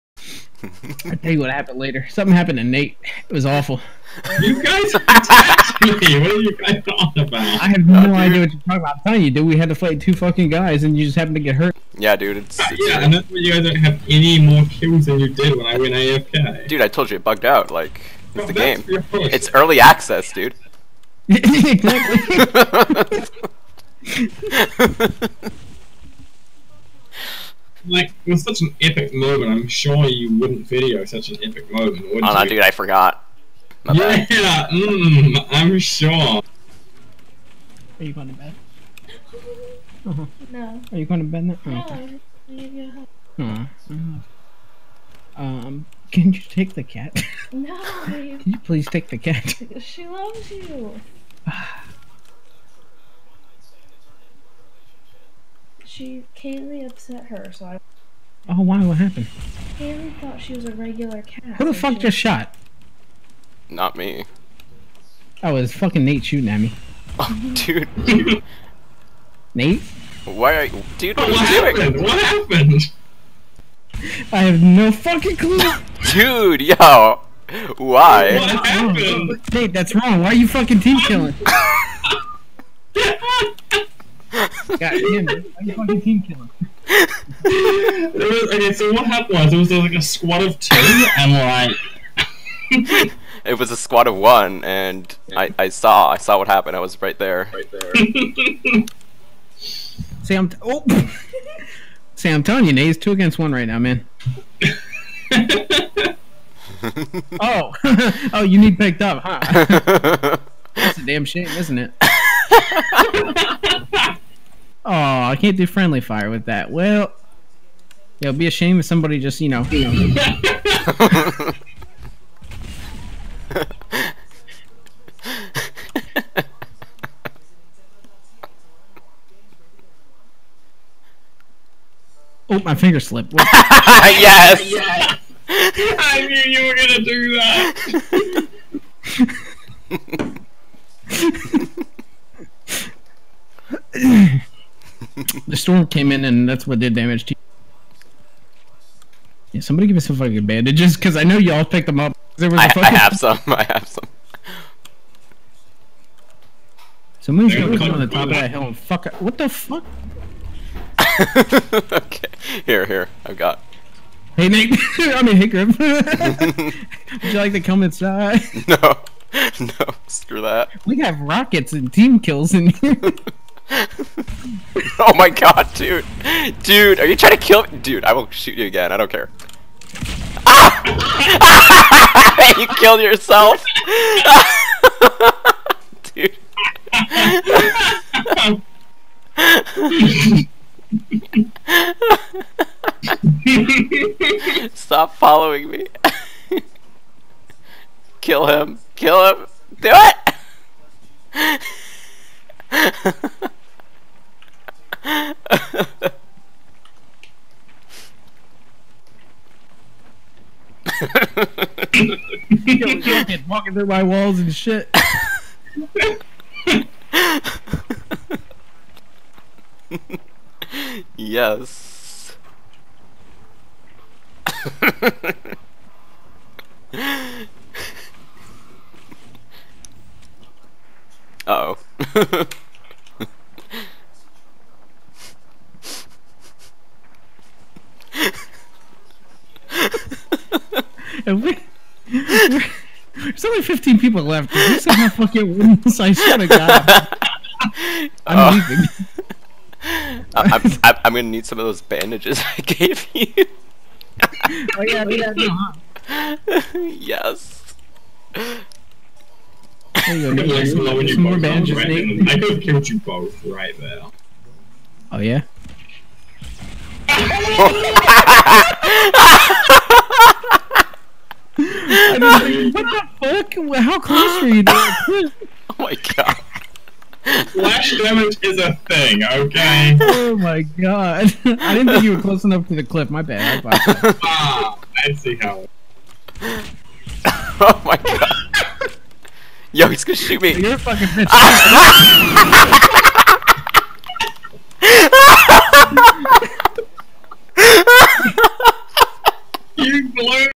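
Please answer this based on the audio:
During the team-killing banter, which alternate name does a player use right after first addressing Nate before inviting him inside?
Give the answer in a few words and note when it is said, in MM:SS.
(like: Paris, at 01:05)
Grim, at 02:45.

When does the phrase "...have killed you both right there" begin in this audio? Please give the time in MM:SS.
04:22.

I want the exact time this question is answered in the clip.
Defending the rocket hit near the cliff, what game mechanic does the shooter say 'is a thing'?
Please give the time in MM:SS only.
04:37.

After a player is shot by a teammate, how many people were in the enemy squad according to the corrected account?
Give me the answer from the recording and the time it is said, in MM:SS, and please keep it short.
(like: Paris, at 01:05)
1, at 01:33.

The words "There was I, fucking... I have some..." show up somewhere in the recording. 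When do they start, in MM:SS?
02:32.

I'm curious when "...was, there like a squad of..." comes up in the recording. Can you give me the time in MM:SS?
01:29.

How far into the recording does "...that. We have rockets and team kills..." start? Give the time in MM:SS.
02:50.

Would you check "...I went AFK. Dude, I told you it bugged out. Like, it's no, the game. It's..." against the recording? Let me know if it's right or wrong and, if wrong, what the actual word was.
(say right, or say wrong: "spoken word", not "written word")
right.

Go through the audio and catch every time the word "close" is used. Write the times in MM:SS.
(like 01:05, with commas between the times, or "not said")
04:33, 04:42.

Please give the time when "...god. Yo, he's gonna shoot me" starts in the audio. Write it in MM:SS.
04:47.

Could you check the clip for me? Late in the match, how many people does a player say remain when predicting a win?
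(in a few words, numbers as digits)
15.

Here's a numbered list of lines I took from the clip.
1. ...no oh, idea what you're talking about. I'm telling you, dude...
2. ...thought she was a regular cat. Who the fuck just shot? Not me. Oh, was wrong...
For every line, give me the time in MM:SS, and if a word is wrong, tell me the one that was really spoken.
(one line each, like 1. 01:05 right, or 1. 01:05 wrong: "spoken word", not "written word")
1. 00:07 right
2. 01:00 wrong: "fucking", not "wrong".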